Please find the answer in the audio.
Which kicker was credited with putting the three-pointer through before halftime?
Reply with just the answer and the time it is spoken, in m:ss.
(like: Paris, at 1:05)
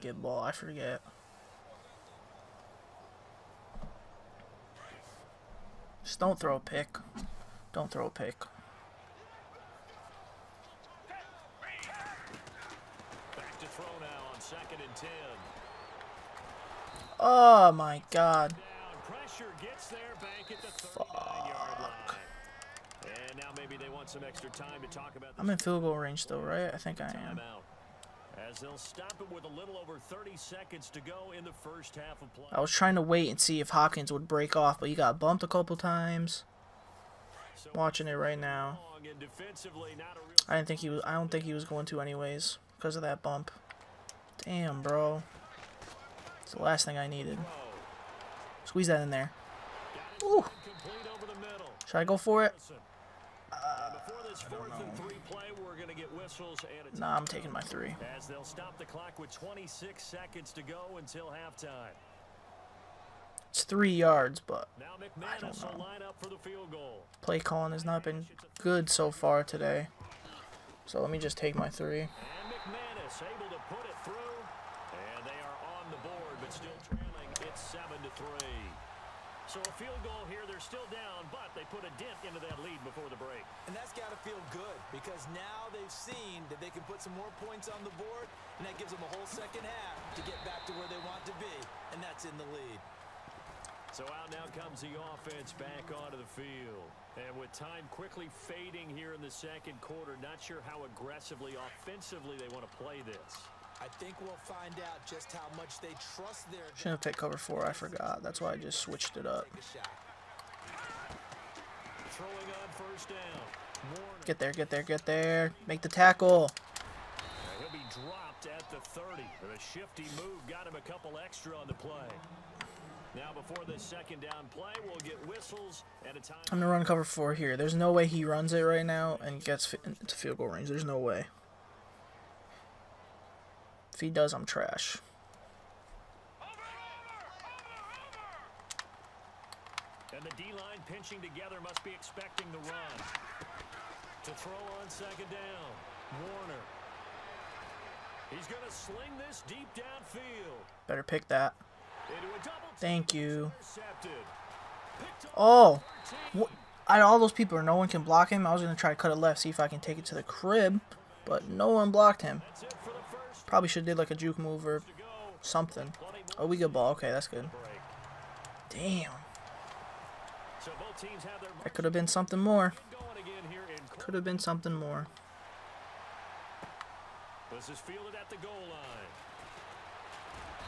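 McManus, at 1:12.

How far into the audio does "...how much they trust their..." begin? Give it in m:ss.
1:45.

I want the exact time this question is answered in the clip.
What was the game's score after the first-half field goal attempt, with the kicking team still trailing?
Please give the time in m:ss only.
1:17.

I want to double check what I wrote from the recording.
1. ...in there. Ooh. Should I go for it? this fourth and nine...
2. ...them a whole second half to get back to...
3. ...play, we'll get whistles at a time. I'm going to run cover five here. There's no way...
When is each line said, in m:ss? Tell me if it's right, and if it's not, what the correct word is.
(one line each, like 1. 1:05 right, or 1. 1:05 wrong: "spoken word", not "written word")
1. 0:49 wrong: "three", not "nine"
2. 1:28 right
3. 2:04 wrong: "four", not "five".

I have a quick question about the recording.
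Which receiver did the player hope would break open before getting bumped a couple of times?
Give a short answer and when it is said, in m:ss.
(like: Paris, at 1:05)
Hopkins, at 0:33.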